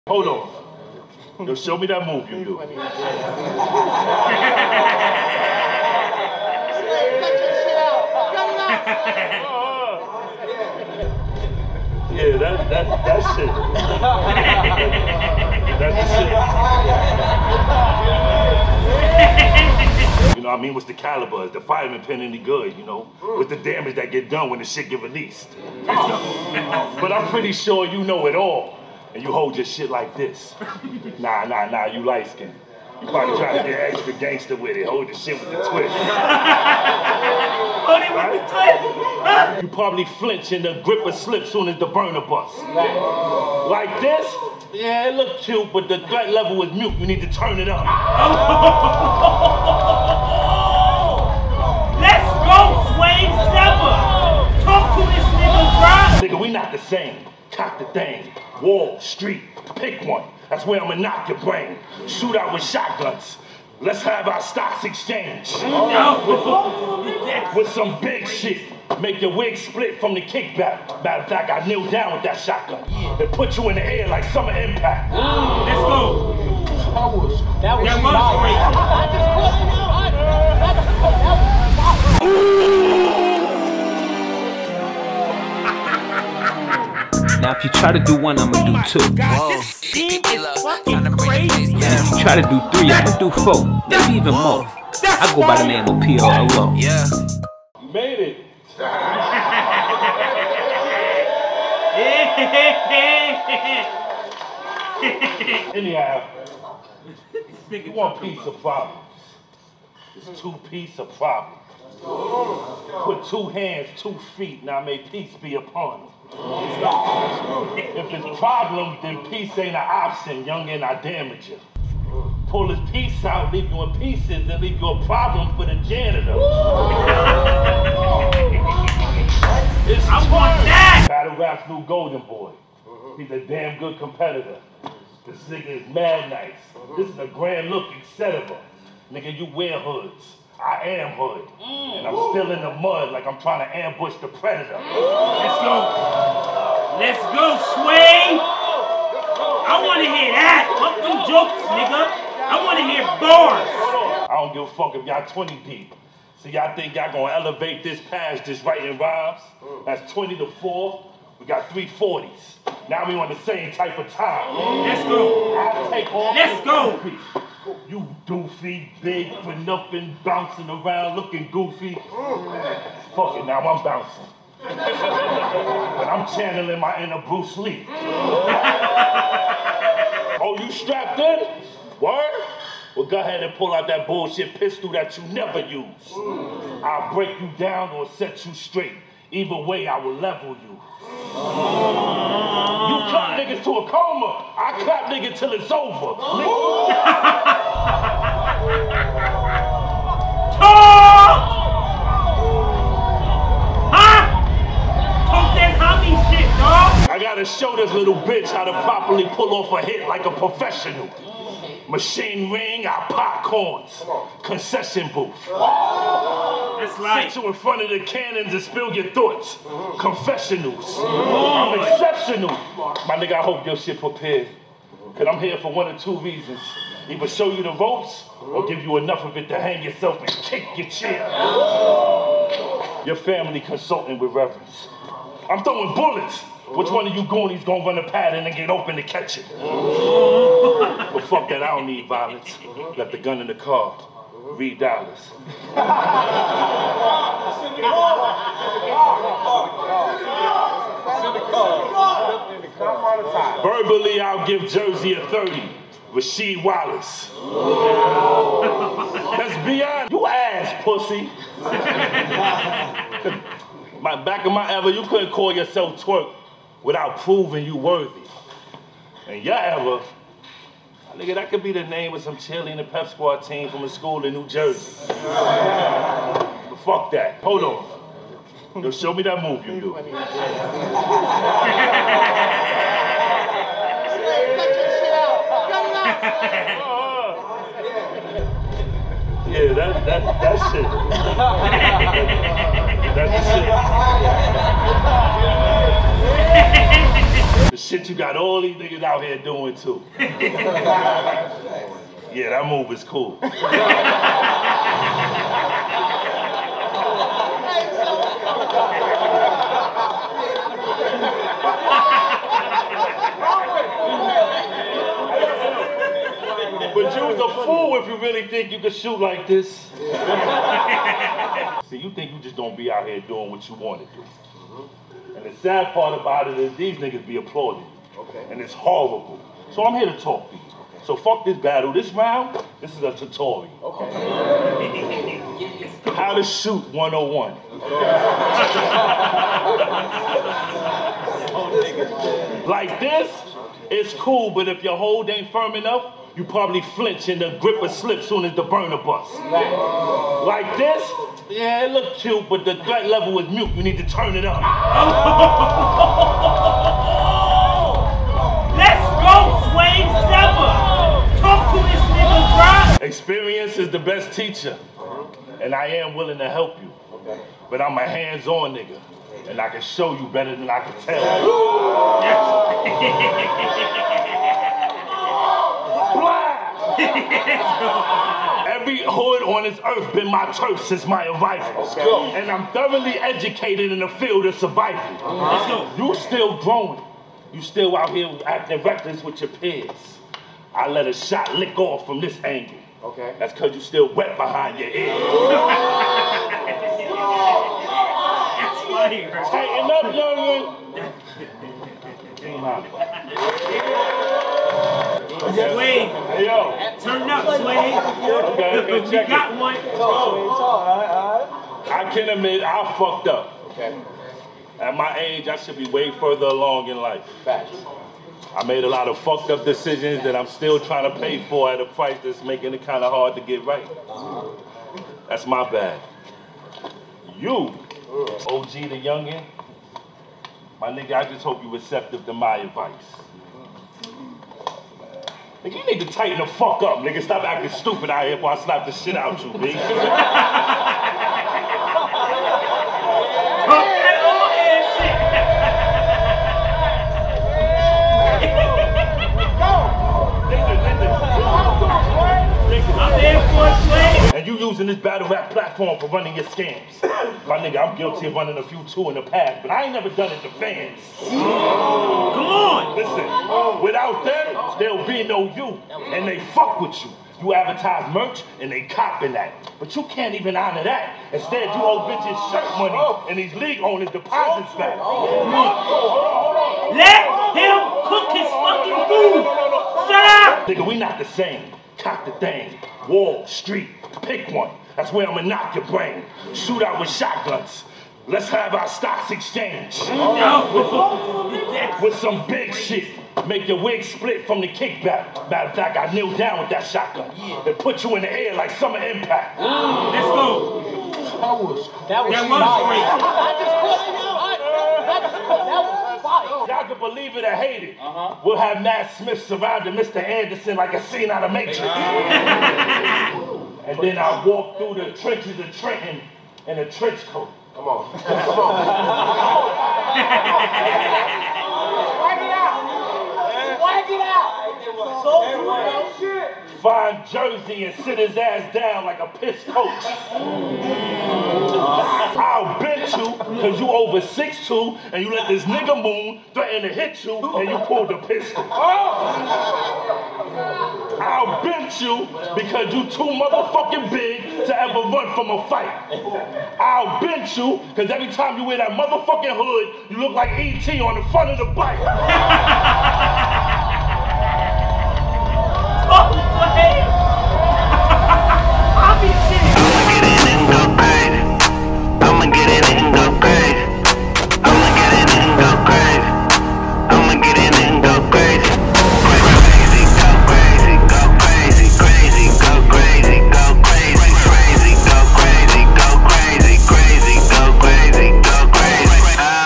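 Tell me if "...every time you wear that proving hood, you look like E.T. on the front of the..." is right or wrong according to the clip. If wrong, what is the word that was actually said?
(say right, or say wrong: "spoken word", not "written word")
wrong: "motherfucking", not "proving".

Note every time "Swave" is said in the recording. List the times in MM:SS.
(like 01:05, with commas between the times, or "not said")
00:52, 05:59.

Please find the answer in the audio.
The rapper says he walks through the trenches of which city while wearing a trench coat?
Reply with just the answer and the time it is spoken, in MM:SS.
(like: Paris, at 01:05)
Trenton, at 08:35.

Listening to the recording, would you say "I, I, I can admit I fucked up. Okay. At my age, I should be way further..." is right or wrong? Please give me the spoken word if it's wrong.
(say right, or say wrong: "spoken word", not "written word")
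right.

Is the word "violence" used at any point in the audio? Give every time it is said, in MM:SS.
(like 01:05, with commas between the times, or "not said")
04:02.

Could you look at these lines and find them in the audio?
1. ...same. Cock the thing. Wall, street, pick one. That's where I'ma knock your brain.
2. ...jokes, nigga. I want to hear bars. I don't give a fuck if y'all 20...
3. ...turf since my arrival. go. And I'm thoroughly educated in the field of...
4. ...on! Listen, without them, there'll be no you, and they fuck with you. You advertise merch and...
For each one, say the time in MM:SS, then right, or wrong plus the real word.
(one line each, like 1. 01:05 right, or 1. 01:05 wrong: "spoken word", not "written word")
1. 00:56 right
2. 02:31 right
3. 06:20 right
4. 07:41 right.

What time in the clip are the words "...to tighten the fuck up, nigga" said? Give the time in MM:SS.
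07:16.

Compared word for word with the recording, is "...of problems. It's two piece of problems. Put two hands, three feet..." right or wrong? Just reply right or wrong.
wrong.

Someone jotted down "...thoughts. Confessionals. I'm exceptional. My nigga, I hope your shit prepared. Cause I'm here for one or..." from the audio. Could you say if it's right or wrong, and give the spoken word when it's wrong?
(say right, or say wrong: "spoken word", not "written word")
right.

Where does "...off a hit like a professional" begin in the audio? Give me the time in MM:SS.
03:29.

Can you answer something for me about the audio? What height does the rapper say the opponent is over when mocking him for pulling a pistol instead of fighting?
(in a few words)
6'2".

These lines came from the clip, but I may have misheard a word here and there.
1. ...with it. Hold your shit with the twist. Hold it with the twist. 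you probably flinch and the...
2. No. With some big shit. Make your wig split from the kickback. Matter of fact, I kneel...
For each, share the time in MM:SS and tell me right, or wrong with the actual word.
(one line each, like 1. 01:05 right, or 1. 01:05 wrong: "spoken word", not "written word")
1. 00:34 right
2. 08:10 right.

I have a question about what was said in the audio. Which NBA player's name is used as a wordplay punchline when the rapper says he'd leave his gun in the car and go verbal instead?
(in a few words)
Rasheed Wallace.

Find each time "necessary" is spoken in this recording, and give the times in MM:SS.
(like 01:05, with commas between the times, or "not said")
not said.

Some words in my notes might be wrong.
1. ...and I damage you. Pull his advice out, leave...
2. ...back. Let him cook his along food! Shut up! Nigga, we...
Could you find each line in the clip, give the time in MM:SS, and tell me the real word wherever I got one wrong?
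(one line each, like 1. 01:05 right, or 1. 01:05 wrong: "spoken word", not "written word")
1. 02:00 wrong: "piece", not "advice"
2. 07:54 wrong: "fucking", not "along".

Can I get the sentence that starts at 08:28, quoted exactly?
we'll have Matt Smith surrounding Mr.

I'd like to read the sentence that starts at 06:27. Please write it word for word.
You still out here acting reckless with your peers.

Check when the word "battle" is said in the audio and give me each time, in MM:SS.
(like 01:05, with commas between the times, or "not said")
02:11, 05:31, 07:34.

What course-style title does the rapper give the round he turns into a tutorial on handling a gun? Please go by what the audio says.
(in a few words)
How to Shoot 101.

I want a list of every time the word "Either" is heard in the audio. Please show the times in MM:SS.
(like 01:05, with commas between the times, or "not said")
03:09, 03:47.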